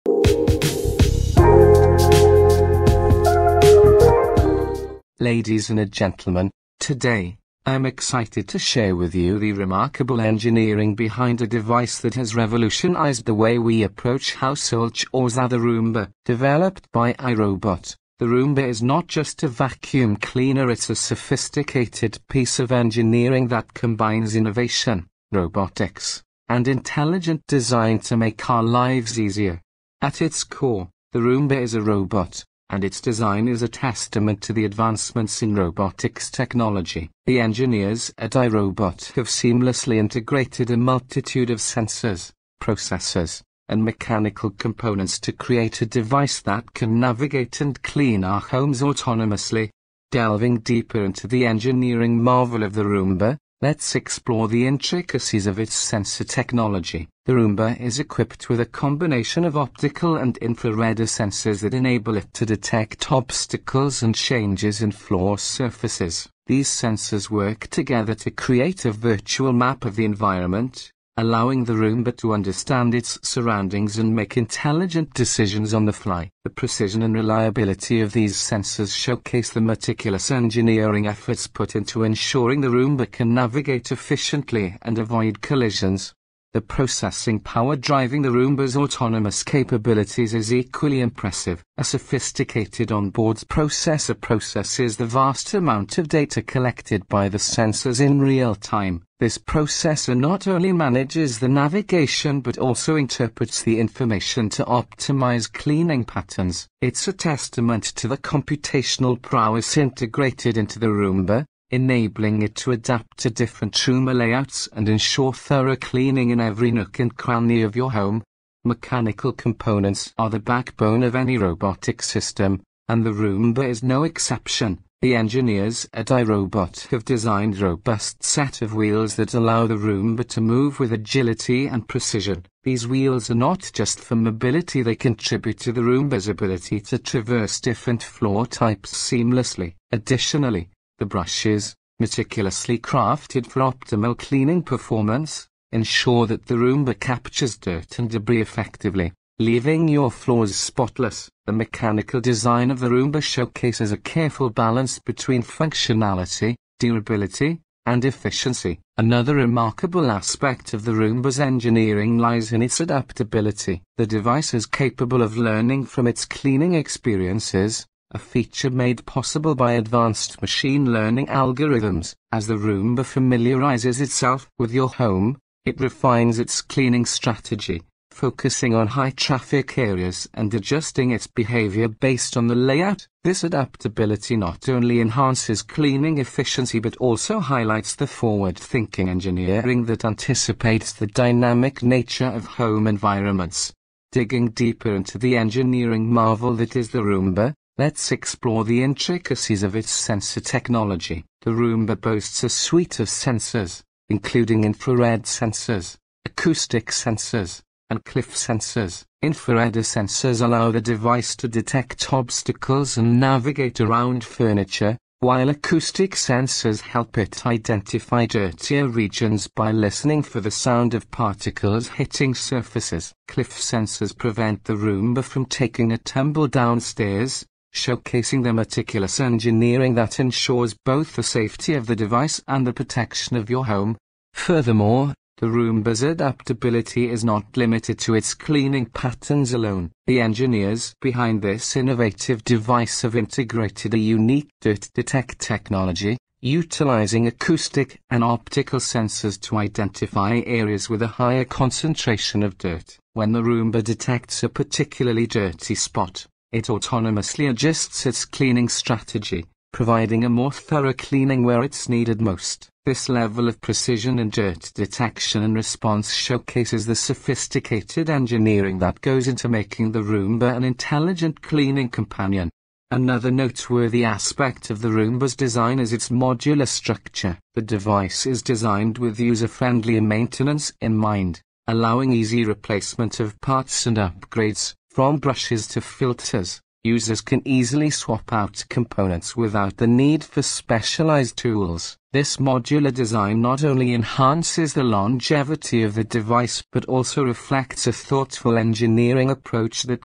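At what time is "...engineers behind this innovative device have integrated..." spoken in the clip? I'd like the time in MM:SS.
04:00.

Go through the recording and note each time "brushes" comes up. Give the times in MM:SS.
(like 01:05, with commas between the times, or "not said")
02:21, 04:45.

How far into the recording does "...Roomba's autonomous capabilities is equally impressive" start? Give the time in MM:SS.
01:28.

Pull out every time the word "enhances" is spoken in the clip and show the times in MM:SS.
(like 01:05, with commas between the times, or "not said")
03:04, 04:53.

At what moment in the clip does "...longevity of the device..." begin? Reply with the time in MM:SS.
04:54.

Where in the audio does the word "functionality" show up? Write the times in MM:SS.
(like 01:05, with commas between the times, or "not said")
02:35.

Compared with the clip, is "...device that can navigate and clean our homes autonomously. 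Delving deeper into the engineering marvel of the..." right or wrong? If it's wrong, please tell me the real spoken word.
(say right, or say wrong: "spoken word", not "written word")
right.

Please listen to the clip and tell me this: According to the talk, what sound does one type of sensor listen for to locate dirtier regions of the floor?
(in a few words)
particles hitting surfaces.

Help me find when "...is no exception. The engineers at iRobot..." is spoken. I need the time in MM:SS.
02:03.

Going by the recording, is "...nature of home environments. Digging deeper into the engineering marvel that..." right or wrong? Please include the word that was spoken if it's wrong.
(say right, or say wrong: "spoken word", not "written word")
right.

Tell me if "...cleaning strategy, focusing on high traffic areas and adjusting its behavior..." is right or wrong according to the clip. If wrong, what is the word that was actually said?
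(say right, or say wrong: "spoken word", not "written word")
right.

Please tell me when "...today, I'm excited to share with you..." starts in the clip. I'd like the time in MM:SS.
00:06.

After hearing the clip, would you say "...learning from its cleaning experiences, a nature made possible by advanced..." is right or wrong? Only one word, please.
wrong.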